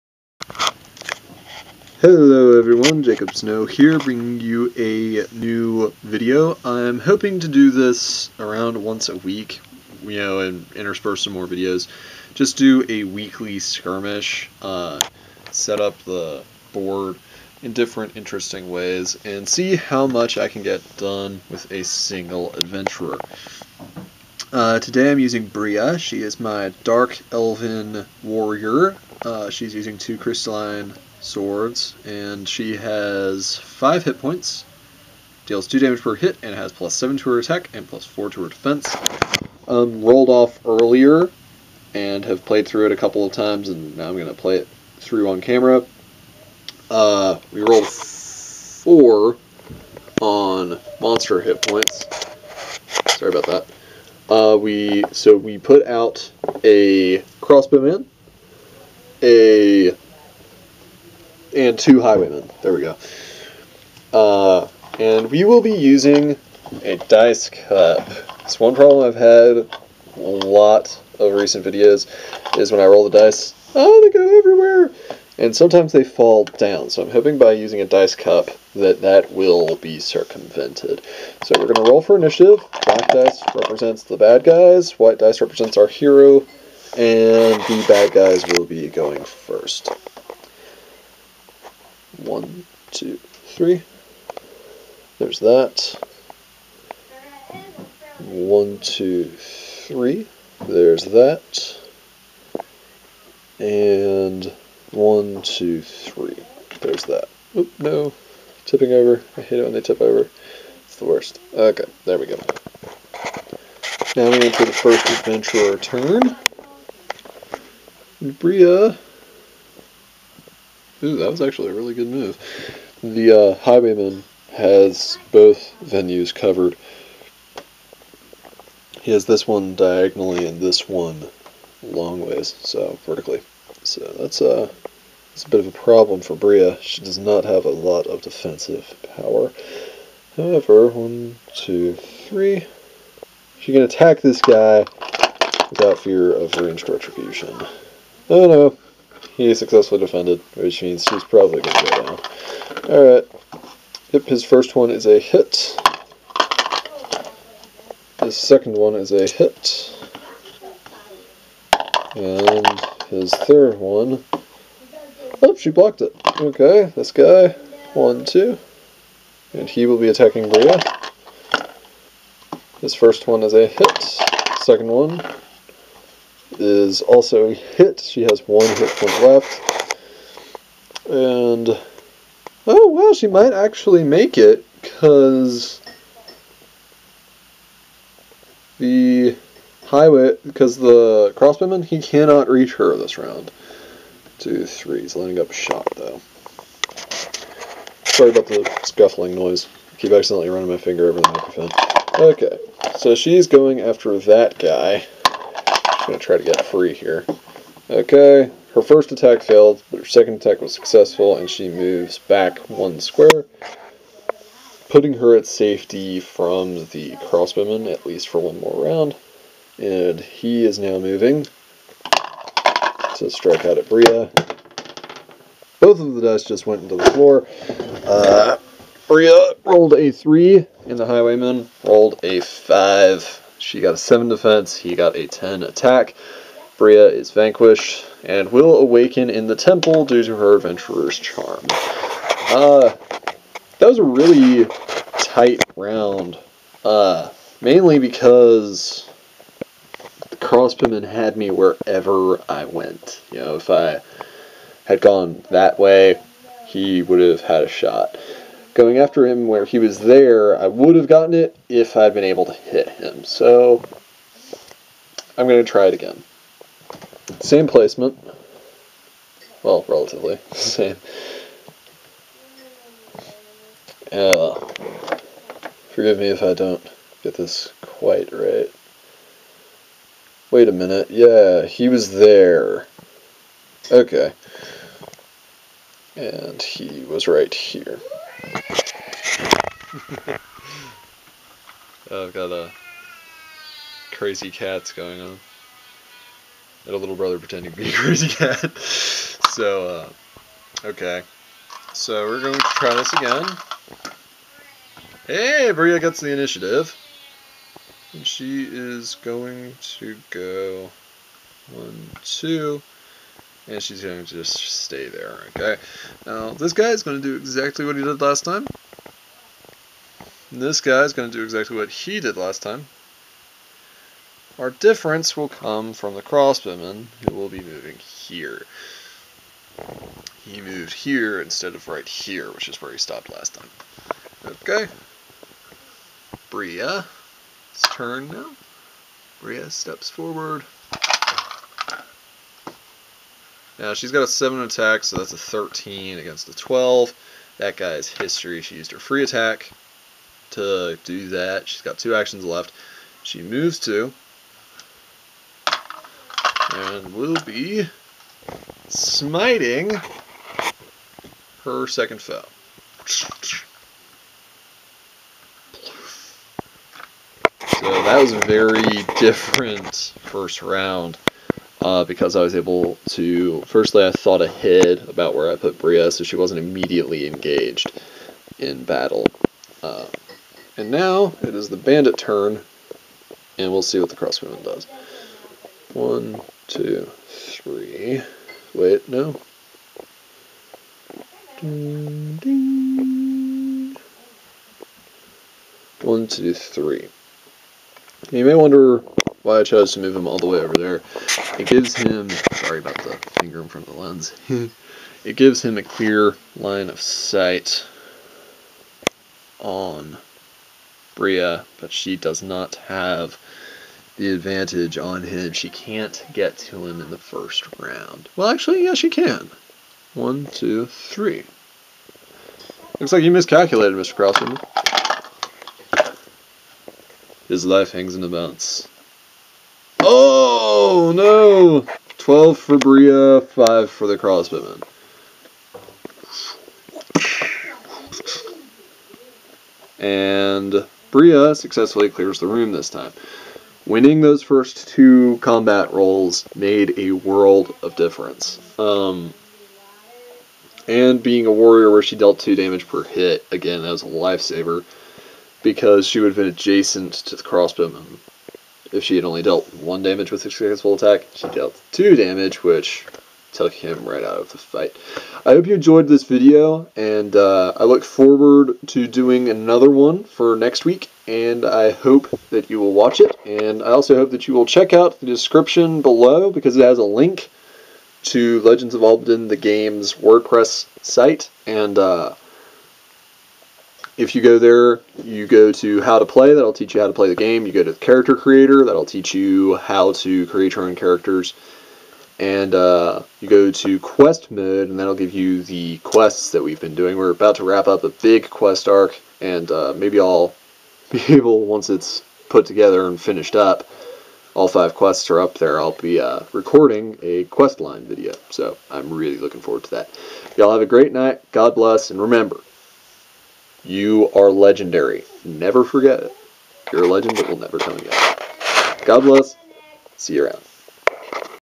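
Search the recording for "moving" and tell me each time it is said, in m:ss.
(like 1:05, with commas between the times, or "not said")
3:40, 5:27.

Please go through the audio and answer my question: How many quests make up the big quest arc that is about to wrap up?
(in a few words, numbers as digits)
5.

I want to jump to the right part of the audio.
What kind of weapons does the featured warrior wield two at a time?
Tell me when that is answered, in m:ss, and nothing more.
0:30.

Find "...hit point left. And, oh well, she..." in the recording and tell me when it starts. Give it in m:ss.
2:58.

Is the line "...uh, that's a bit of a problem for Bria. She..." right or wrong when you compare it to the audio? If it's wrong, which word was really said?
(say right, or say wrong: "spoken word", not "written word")
right.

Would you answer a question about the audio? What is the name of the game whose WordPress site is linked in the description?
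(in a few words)
Legends of Albadyn.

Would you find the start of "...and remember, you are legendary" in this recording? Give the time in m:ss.
8:32.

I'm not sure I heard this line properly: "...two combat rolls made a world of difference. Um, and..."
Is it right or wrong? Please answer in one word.
right.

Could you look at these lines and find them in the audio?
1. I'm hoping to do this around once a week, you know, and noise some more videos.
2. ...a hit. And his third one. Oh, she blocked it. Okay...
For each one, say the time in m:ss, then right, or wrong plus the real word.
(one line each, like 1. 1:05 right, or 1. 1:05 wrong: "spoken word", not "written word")
1. 0:06 wrong: "intersperse", not "noise"
2. 2:39 right.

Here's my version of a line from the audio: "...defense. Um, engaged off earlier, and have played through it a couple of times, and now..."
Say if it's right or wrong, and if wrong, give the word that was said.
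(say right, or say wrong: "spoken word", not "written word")
wrong: "rolled", not "engaged".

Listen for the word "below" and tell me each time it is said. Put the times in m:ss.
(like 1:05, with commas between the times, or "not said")
7:56.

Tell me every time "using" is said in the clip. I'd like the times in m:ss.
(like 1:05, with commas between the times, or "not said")
0:25, 0:29, 1:05, 1:17.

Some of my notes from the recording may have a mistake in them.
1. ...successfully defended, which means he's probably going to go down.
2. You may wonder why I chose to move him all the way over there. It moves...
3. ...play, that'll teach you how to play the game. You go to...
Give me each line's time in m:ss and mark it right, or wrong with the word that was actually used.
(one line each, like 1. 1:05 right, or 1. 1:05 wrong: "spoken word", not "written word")
1. 2:29 right
2. 6:38 wrong: "gives", not "moves"
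3. 8:06 right.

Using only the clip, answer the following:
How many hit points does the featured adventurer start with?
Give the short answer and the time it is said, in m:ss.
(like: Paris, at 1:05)
5, at 0:33.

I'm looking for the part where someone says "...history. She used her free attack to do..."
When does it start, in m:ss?
5:48.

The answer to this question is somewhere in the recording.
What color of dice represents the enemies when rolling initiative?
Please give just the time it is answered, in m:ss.
1:22.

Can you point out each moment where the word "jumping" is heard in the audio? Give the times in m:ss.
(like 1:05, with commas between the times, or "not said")
not said.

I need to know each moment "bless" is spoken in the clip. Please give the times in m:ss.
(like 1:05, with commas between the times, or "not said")
8:31, 8:39.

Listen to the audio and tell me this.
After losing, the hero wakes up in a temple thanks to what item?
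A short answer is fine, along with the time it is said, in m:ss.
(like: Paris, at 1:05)
adventurer's charm, at 4:00.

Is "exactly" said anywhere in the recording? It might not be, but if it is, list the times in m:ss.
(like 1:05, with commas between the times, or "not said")
5:17, 5:21.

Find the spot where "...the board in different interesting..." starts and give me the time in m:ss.
0:16.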